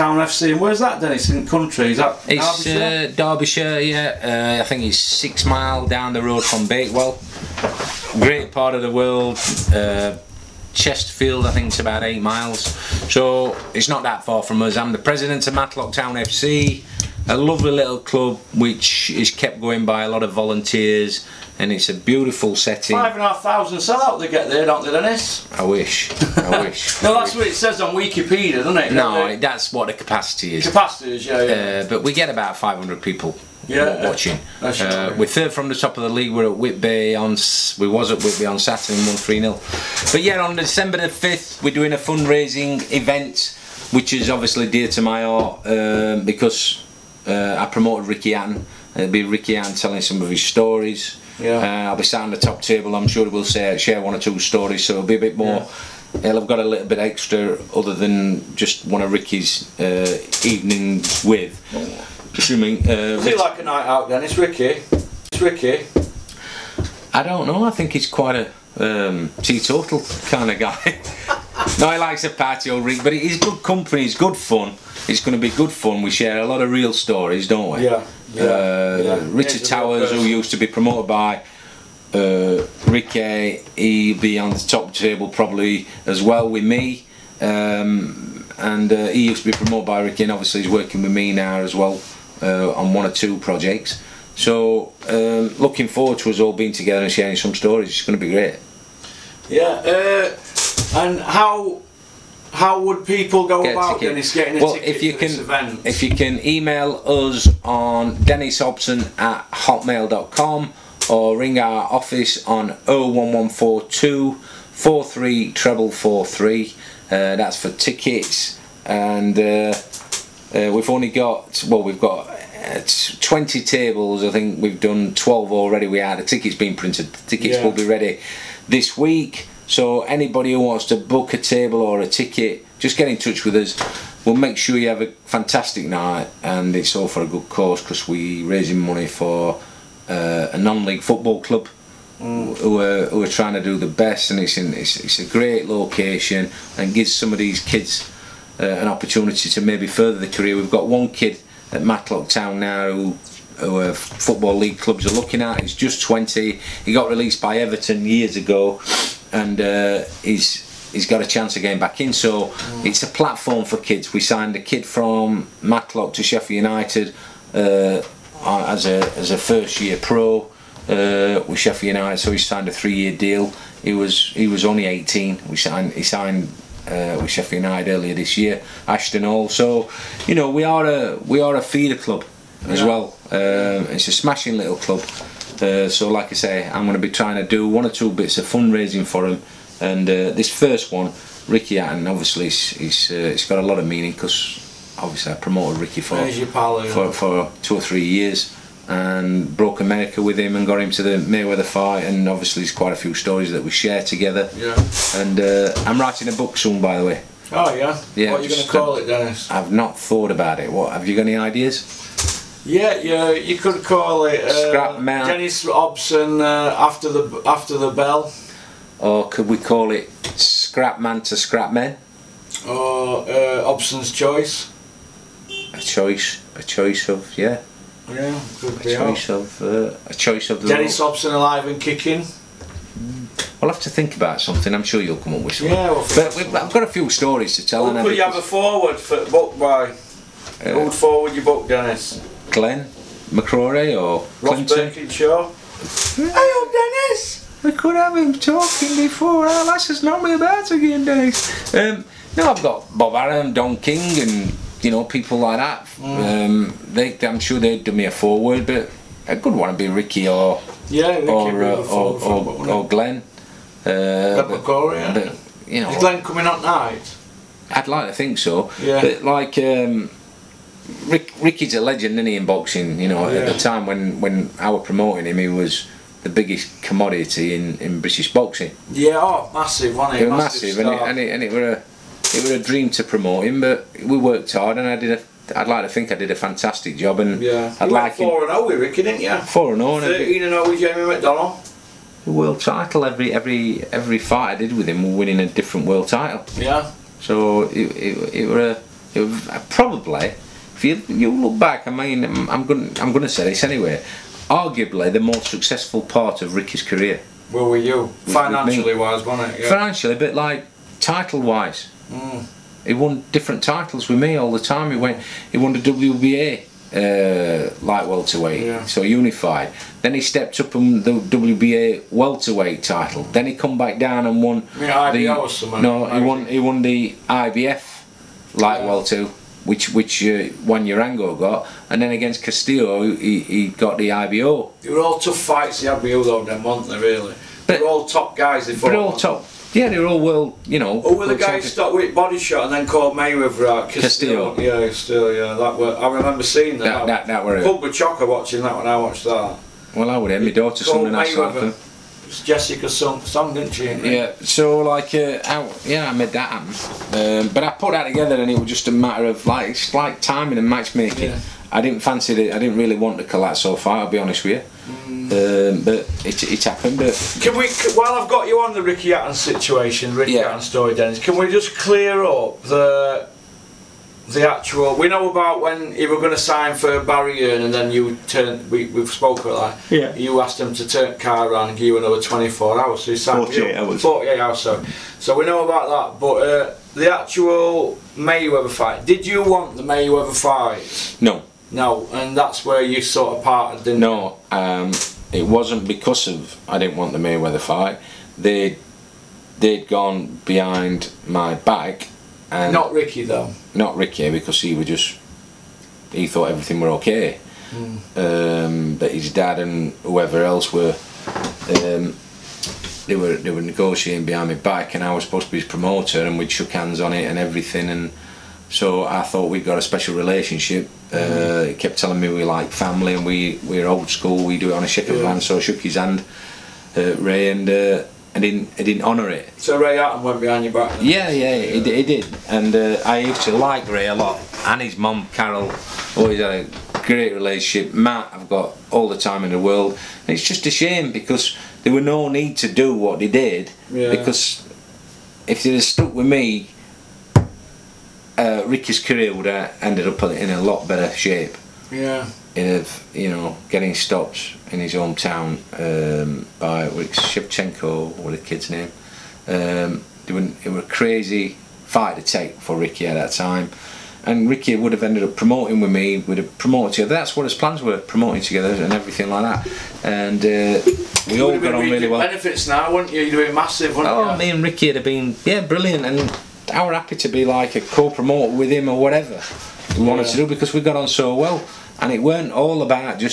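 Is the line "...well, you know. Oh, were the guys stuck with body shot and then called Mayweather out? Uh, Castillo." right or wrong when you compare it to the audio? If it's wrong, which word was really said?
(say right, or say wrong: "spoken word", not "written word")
right.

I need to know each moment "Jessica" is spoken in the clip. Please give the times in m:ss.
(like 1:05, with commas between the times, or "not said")
5:52.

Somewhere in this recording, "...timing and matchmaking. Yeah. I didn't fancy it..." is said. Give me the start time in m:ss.
6:00.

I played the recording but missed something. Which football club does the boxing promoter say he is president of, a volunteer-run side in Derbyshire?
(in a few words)
Matlock Town FC.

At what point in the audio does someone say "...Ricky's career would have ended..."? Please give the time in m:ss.
7:28.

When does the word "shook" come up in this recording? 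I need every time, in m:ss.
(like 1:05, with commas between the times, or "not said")
6:56, 7:05.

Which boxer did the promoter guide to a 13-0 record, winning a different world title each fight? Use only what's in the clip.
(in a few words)
Jamie McDonnell.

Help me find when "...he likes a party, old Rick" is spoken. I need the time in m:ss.
1:11.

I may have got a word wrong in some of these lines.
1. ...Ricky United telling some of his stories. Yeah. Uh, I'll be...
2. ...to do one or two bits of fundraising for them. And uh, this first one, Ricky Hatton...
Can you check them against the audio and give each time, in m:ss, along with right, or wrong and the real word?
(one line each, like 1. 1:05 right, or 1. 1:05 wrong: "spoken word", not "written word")
1. 0:49 wrong: "Ann", not "United"
2. 3:07 right.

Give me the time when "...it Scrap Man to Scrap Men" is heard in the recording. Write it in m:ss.
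3:39.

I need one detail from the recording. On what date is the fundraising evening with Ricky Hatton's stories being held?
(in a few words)
December 5.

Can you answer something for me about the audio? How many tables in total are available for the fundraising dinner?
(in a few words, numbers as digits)
20.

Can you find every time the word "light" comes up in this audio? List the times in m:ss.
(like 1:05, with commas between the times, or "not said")
5:17, 5:28.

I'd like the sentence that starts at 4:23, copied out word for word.
Uh, but, McCrory, but, you know, is Glenn coming up night?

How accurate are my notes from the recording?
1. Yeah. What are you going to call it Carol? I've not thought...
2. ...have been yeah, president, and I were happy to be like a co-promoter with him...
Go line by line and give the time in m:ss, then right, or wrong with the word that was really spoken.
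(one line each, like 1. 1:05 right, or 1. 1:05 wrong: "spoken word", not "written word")
1. 3:28 wrong: "Dennis", not "Carol"
2. 7:54 wrong: "brilliant", not "president".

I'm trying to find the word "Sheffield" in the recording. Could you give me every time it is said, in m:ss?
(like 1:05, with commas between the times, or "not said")
2:46, 2:51, 2:57.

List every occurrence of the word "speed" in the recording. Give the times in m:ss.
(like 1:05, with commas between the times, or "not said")
not said.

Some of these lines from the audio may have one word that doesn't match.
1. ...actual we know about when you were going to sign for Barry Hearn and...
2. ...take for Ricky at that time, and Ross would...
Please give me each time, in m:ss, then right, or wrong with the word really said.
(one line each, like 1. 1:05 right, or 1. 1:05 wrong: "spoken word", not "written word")
1. 6:14 right
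2. 7:42 wrong: "Ricky", not "Ross".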